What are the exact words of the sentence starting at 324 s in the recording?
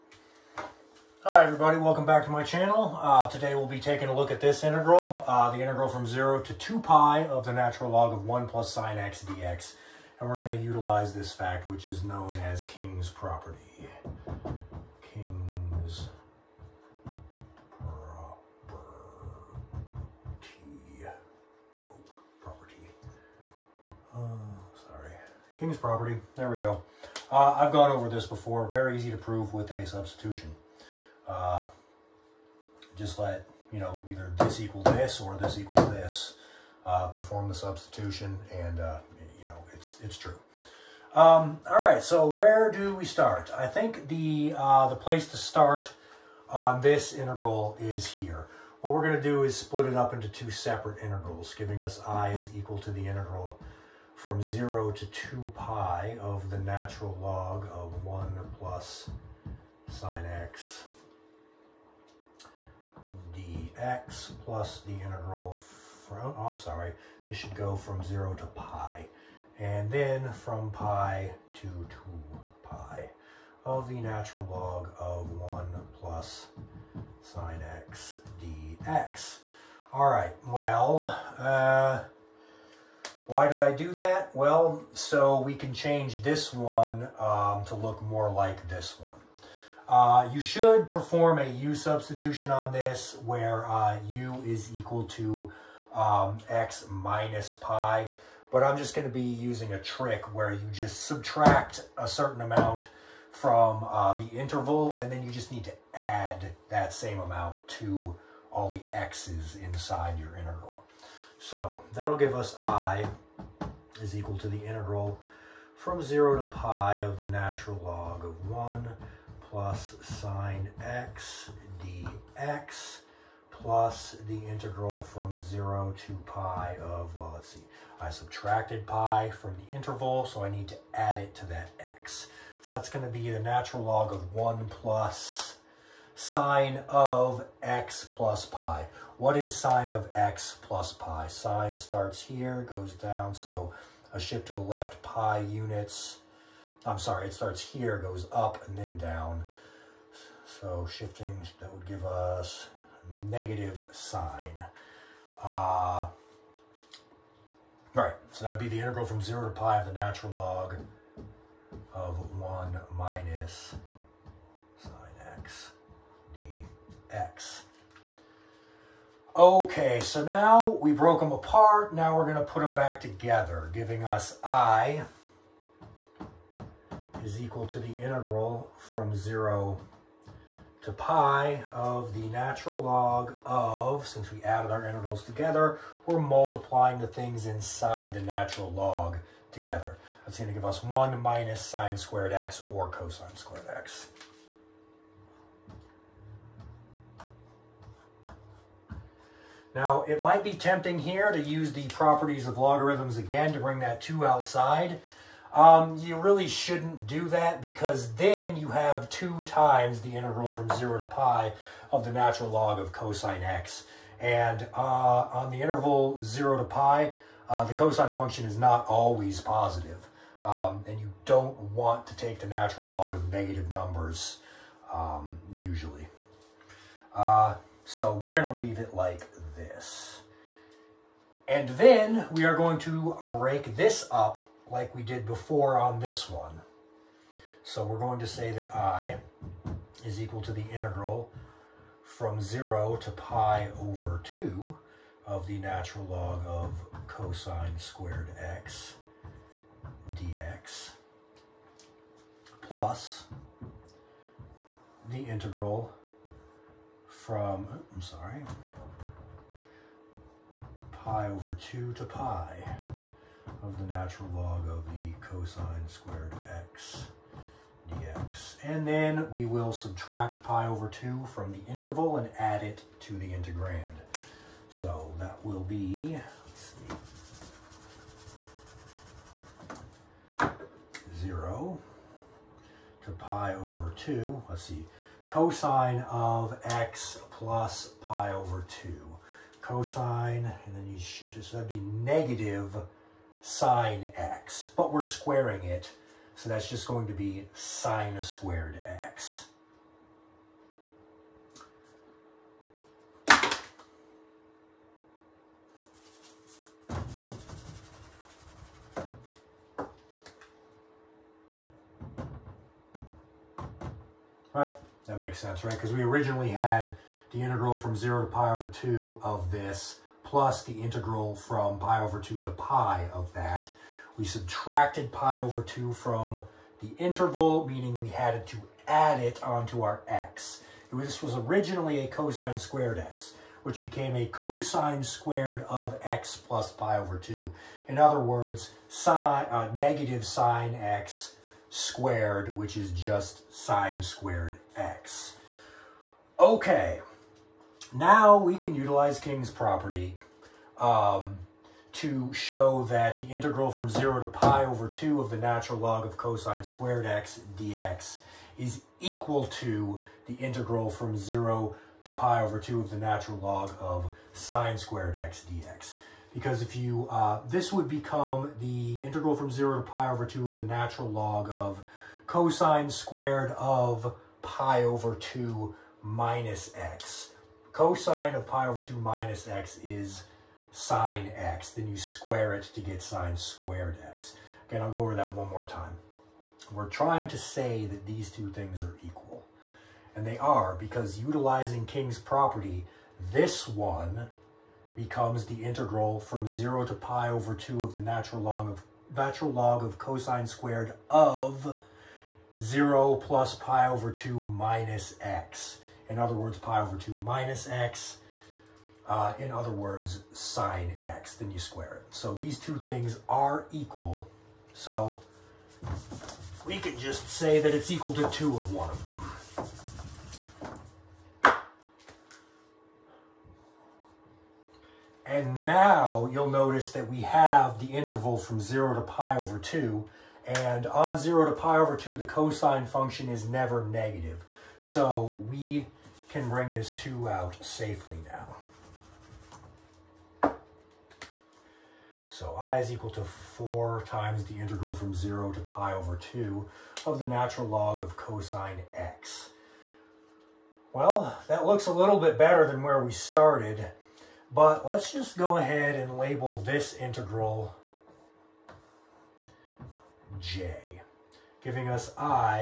We subtracted pi over 2 from the interval, meaning we had to add it onto our x.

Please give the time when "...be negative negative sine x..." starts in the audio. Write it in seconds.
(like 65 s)
291 s.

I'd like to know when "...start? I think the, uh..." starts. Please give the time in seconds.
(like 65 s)
43 s.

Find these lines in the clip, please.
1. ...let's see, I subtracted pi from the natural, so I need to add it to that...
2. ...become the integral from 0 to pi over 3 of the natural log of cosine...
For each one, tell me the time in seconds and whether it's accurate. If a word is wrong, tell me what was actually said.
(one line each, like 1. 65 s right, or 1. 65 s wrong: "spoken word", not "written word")
1. 127 s wrong: "interval", not "natural"
2. 367 s wrong: "2", not "3".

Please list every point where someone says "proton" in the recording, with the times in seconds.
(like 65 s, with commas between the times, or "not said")
not said.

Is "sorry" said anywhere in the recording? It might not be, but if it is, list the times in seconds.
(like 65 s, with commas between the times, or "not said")
24 s, 66 s, 146 s, 258 s.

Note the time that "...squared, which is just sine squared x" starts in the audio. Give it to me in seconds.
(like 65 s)
341 s.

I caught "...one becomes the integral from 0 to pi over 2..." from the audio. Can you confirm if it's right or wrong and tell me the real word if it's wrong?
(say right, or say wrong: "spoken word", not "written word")
right.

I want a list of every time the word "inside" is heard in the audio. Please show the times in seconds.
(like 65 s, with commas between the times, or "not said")
109 s, 187 s.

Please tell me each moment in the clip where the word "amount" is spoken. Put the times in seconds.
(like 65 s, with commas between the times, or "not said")
102 s, 107 s.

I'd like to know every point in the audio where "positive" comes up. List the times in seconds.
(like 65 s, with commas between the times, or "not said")
219 s.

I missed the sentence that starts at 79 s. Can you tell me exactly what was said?
All right, well, uh, why did I do that?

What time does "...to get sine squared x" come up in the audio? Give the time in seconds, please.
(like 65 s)
382 s.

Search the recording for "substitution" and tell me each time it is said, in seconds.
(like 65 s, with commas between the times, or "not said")
29 s, 37 s, 91 s.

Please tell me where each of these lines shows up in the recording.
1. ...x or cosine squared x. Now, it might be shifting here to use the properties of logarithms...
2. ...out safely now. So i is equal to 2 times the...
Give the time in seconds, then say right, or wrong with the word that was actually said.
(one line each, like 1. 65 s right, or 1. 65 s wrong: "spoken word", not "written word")
1. 192 s wrong: "tempting", not "shifting"
2. 437 s wrong: "4", not "2".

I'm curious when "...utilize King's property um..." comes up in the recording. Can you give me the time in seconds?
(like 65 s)
348 s.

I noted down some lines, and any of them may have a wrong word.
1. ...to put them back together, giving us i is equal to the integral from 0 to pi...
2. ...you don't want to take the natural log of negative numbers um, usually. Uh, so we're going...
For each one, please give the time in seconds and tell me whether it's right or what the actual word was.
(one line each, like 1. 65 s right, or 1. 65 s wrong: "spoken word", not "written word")
1. 172 s right
2. 220 s right.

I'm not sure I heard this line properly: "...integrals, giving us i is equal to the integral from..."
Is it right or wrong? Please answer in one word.
right.